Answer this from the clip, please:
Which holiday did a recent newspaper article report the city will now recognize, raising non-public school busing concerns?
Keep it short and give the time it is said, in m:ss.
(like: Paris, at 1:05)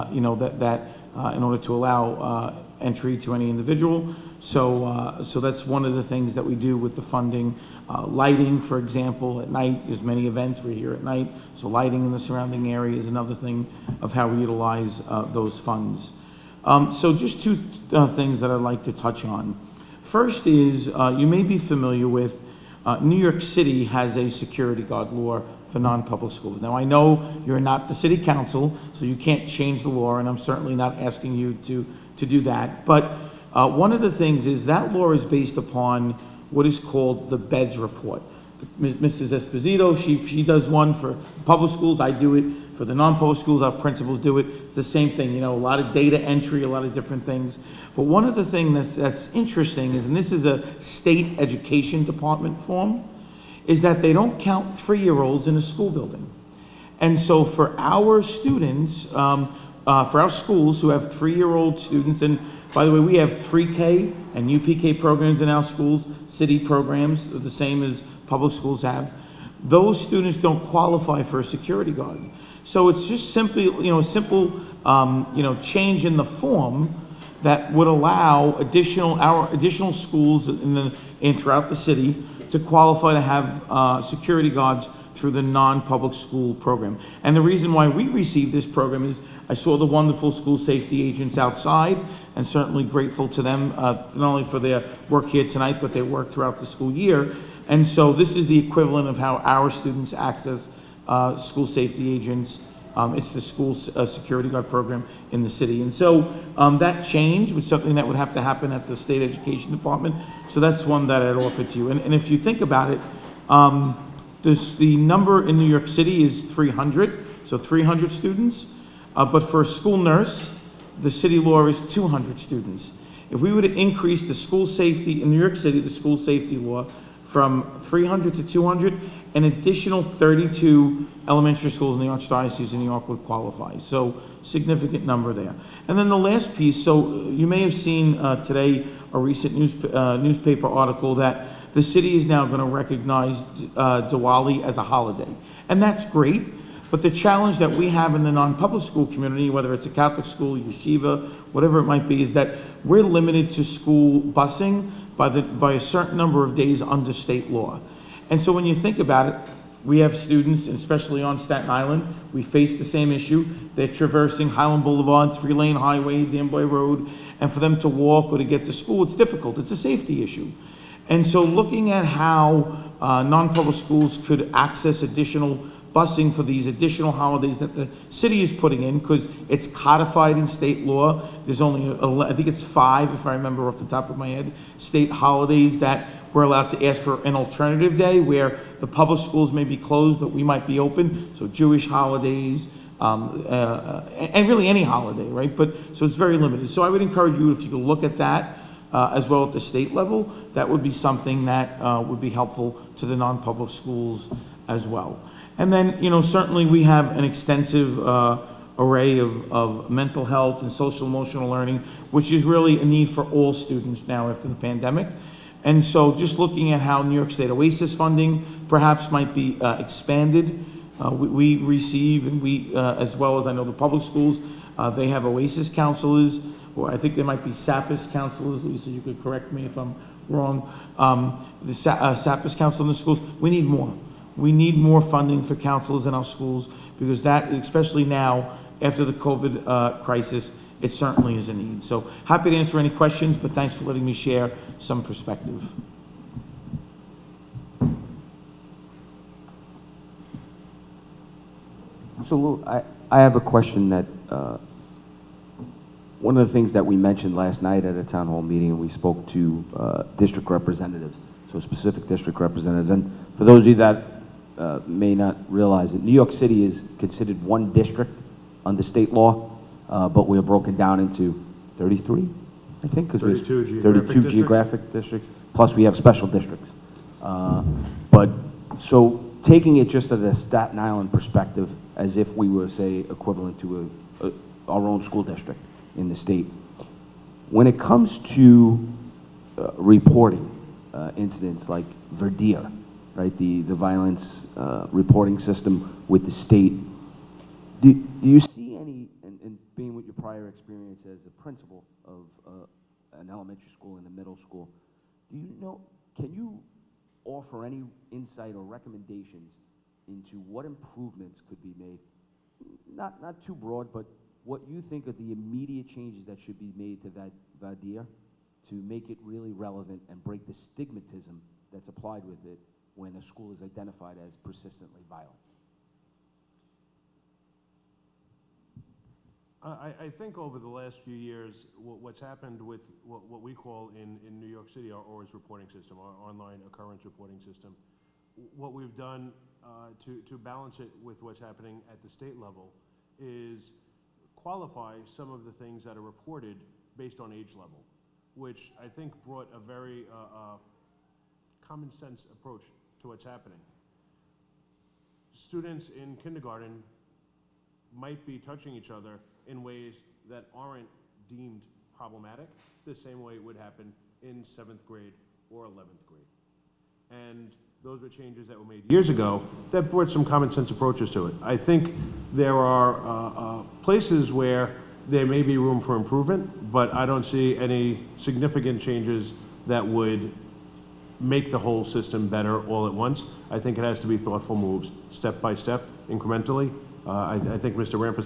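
Diwali, at 2:24.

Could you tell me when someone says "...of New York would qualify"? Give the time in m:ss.
2:12.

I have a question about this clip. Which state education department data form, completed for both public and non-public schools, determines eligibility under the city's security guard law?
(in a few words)
BEDS report.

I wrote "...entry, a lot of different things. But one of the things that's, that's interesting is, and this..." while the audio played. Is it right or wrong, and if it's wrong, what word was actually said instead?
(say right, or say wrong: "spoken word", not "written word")
right.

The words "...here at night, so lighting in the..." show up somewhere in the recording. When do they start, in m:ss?
0:10.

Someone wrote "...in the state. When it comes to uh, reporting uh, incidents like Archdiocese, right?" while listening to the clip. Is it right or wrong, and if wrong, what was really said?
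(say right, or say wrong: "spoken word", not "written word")
wrong: "VADIR", not "Archdiocese".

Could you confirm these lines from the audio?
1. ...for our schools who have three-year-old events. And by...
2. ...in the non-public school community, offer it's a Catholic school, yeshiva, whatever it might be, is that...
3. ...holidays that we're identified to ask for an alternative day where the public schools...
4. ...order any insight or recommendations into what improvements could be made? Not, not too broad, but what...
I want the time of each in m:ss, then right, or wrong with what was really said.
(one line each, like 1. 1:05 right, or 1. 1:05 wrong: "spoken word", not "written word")
1. 1:00 wrong: "students", not "events"
2. 2:28 wrong: "whether", not "offer"
3. 3:05 wrong: "allowed", not "identified"
4. 5:07 wrong: "offer", not "order".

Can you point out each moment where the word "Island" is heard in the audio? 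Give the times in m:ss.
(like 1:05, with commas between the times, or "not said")
2:41, 4:40.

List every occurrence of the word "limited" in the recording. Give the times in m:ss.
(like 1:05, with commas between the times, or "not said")
2:33, 3:16.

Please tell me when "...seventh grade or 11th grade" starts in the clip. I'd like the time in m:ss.
6:04.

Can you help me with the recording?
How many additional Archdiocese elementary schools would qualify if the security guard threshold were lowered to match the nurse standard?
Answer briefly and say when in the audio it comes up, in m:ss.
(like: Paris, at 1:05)
32, at 2:09.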